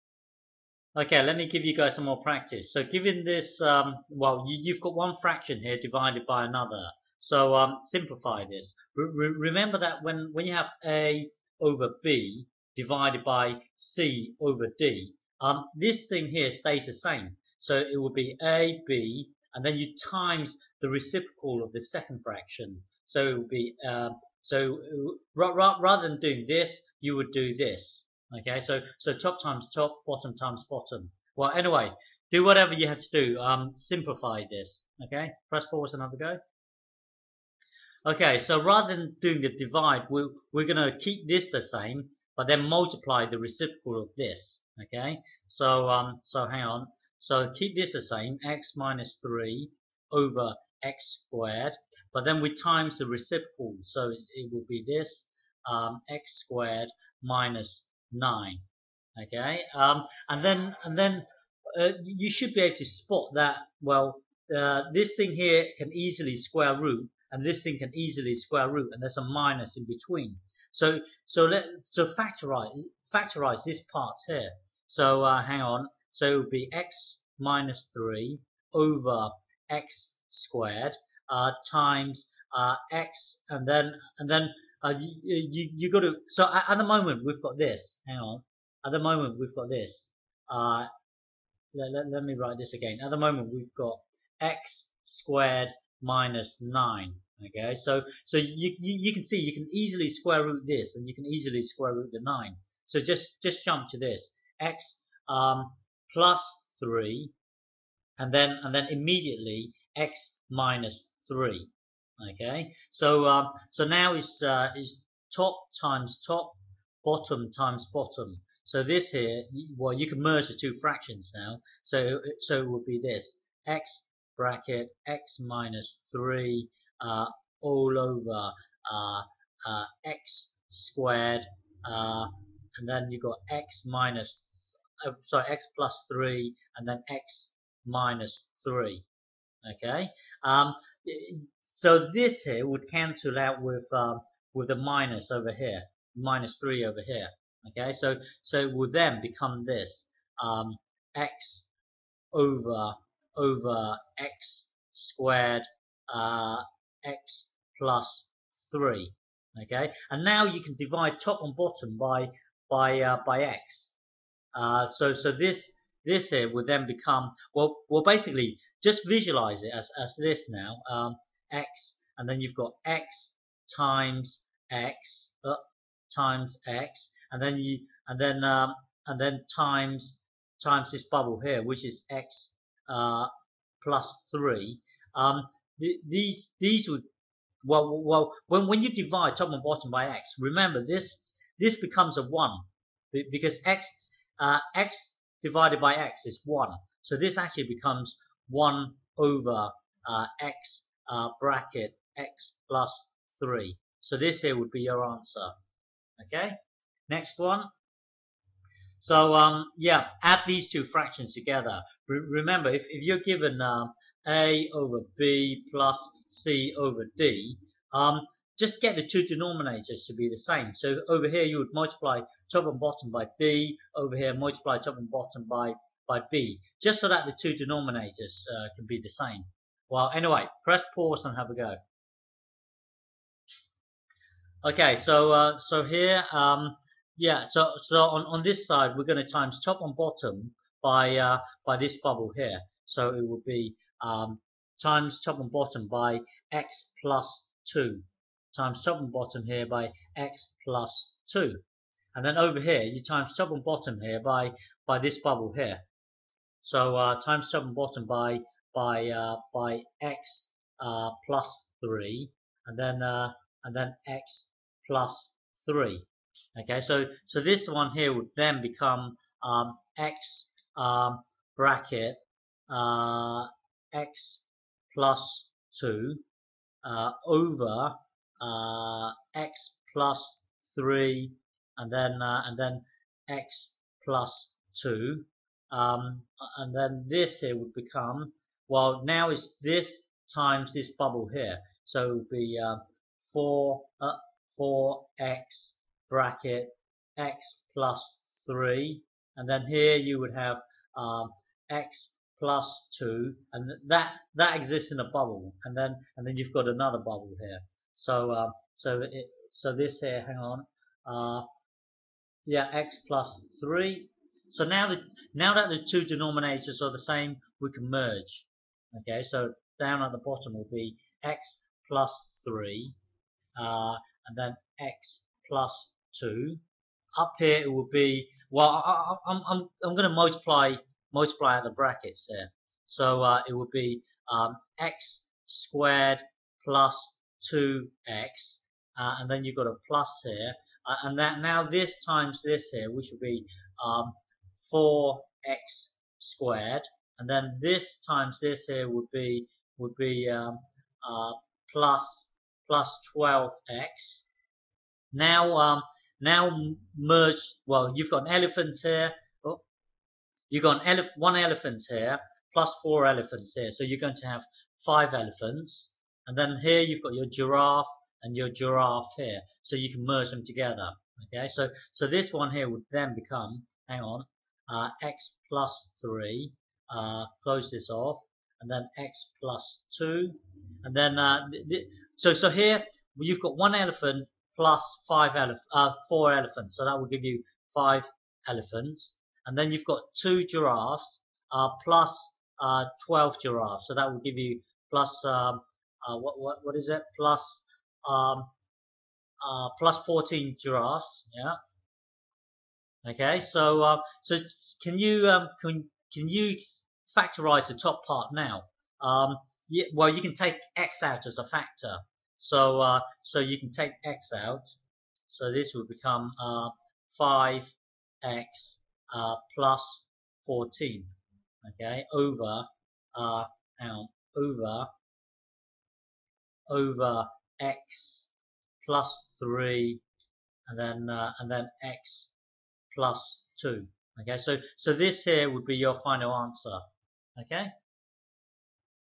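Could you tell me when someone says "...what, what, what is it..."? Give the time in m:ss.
6:36.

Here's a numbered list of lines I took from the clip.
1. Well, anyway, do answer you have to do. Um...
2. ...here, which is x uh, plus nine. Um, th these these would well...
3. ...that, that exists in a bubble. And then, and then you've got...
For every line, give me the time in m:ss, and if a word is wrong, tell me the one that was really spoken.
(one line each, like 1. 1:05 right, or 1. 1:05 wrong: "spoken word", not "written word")
1. 0:31 wrong: "whatever", not "answer"
2. 3:01 wrong: "three", not "nine"
3. 5:03 right.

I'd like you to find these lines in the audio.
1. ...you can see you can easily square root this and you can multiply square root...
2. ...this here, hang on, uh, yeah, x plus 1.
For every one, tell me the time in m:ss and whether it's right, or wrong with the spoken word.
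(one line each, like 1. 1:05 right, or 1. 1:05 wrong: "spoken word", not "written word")
1. 1:39 wrong: "easily", not "multiply"
2. 5:09 wrong: "3", not "1".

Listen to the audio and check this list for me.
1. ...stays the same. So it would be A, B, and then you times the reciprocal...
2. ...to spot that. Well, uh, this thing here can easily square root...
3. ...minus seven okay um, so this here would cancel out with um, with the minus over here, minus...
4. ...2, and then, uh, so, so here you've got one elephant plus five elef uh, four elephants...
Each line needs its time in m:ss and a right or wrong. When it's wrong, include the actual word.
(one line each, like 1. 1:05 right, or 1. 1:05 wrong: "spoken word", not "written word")
1. 0:16 right
2. 1:02 right
3. 2:17 wrong: "three", not "seven"
4. 6:19 right.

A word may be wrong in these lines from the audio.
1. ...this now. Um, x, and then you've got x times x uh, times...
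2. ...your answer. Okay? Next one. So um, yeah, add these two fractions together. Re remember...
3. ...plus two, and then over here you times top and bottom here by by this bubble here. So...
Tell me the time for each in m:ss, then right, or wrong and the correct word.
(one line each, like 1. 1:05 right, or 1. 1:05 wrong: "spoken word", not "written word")
1. 2:50 right
2. 3:24 right
3. 4:10 right.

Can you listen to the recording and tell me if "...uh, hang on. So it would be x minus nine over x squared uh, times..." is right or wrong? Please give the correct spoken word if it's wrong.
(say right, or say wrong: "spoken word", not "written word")
wrong: "three", not "nine".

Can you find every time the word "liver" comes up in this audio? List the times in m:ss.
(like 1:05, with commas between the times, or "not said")
not said.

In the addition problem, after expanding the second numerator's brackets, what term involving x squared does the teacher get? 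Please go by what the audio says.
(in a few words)
4x squared.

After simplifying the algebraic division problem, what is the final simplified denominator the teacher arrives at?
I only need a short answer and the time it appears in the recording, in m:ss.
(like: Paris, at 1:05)
x(x + 3), at 3:20.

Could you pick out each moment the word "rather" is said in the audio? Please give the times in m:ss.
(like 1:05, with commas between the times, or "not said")
0:25, 0:38.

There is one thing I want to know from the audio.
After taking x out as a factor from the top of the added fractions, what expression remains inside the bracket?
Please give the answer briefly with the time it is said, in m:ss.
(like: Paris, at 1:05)
5x + 14, at 6:57.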